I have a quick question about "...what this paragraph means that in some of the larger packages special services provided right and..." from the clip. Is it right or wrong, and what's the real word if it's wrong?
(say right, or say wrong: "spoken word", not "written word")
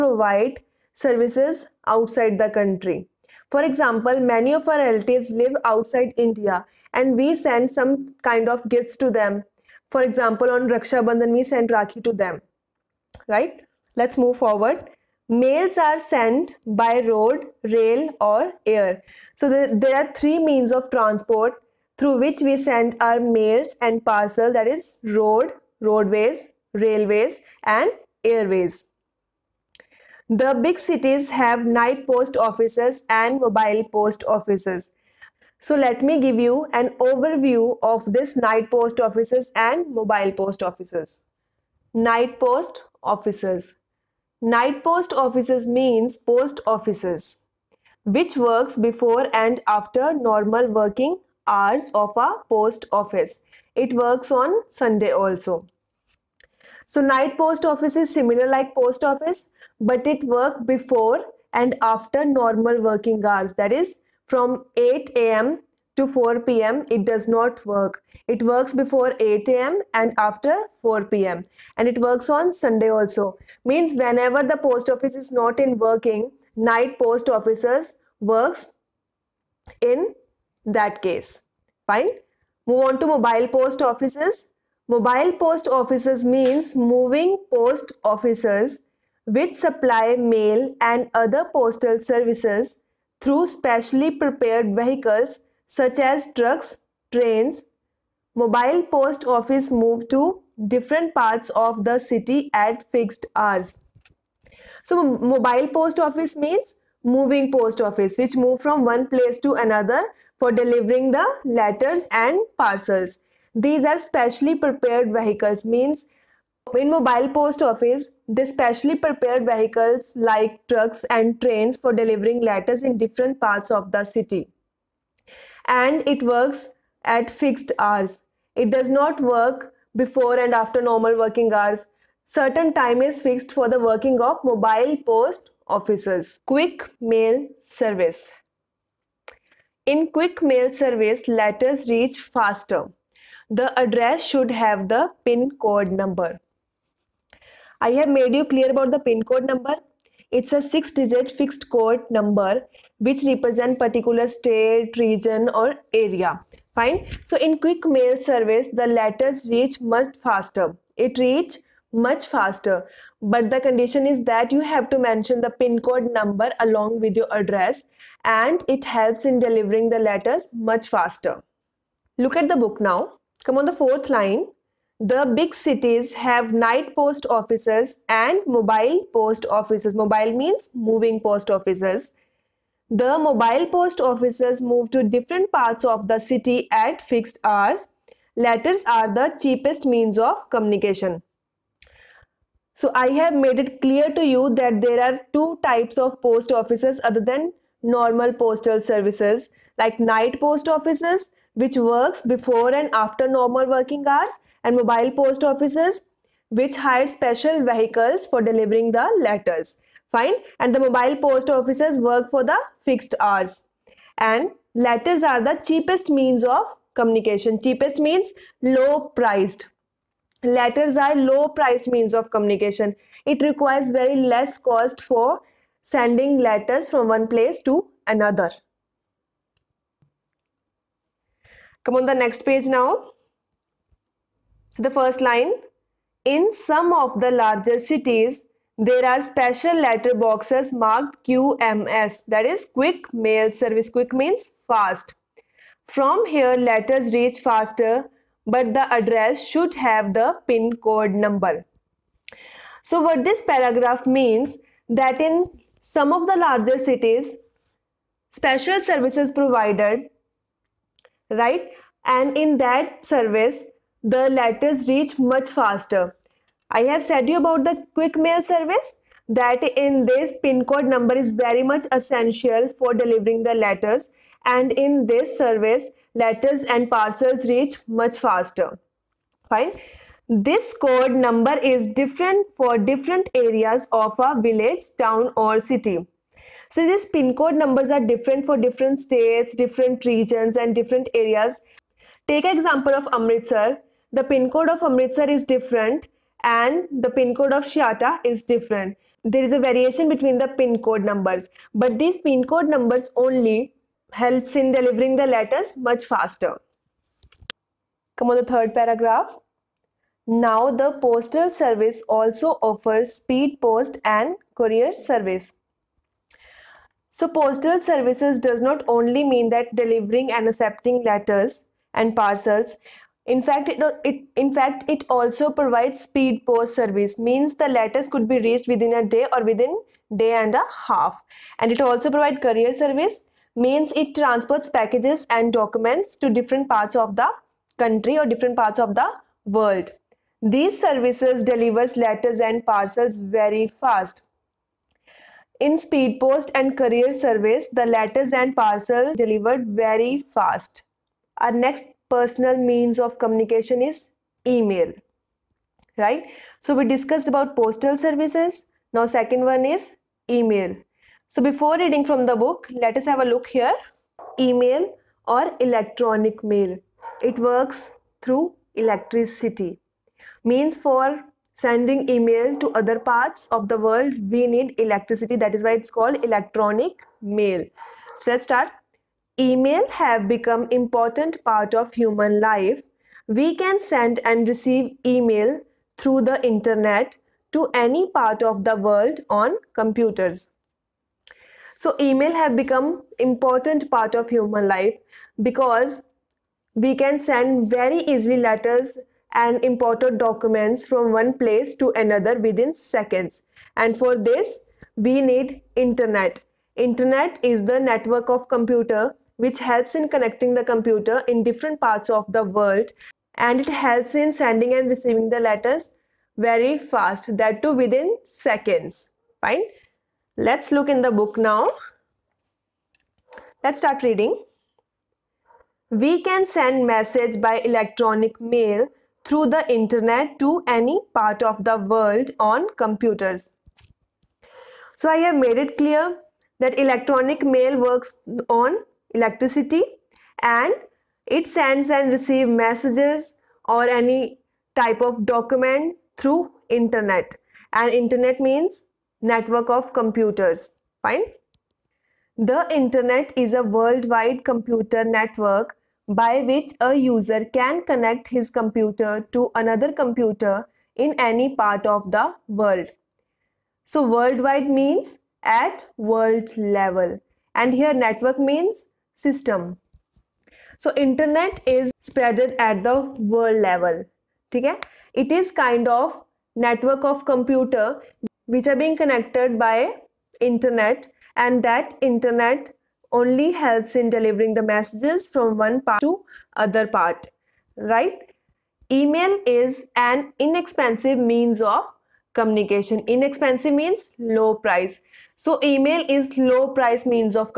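wrong: "cities", not "packages".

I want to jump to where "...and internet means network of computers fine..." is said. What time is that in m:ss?
7:27.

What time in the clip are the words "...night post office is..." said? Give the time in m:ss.
0:57.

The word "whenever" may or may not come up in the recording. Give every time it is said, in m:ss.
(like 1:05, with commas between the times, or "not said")
1:13.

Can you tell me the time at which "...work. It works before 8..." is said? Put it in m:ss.
1:07.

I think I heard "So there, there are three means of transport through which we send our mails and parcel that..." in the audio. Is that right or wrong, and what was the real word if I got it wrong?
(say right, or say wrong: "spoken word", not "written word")
right.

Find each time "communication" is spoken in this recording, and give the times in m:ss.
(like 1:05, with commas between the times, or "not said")
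3:10, 3:36, 3:42, 5:53, 8:12.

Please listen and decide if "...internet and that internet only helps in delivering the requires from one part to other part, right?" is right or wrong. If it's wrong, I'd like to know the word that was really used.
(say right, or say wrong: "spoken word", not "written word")
wrong: "messages", not "requires".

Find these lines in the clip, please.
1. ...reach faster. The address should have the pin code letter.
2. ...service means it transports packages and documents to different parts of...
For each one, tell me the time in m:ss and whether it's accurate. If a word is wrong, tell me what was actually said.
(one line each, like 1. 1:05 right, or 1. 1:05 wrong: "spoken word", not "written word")
1. 2:21 wrong: "number", not "letter"
2. 5:32 right.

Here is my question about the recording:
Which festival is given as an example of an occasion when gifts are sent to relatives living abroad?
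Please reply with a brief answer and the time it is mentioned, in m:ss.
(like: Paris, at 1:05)
Raksha Bandhan, at 0:10.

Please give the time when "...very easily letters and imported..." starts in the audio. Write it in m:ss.
6:37.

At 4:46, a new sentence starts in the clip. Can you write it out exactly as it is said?
So these pin code numbers are different for different states, different regions and different areas.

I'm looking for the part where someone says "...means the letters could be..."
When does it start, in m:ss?
5:27.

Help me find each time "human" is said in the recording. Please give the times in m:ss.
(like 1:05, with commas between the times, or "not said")
6:21, 6:34.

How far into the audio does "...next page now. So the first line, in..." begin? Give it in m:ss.
3:52.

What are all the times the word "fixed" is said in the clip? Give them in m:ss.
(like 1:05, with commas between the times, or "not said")
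1:42, 2:07, 2:13, 2:31, 3:07, 3:32.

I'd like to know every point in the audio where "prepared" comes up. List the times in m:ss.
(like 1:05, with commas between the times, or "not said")
1:34, 1:54, 1:58.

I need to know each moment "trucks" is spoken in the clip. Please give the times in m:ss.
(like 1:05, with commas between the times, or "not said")
1:36, 2:00.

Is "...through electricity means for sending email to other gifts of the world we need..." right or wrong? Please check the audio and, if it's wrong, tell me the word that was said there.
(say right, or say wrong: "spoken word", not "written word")
wrong: "parts", not "gifts".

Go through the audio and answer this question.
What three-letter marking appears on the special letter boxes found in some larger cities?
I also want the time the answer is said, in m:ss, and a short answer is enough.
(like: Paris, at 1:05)
QMS, at 4:01.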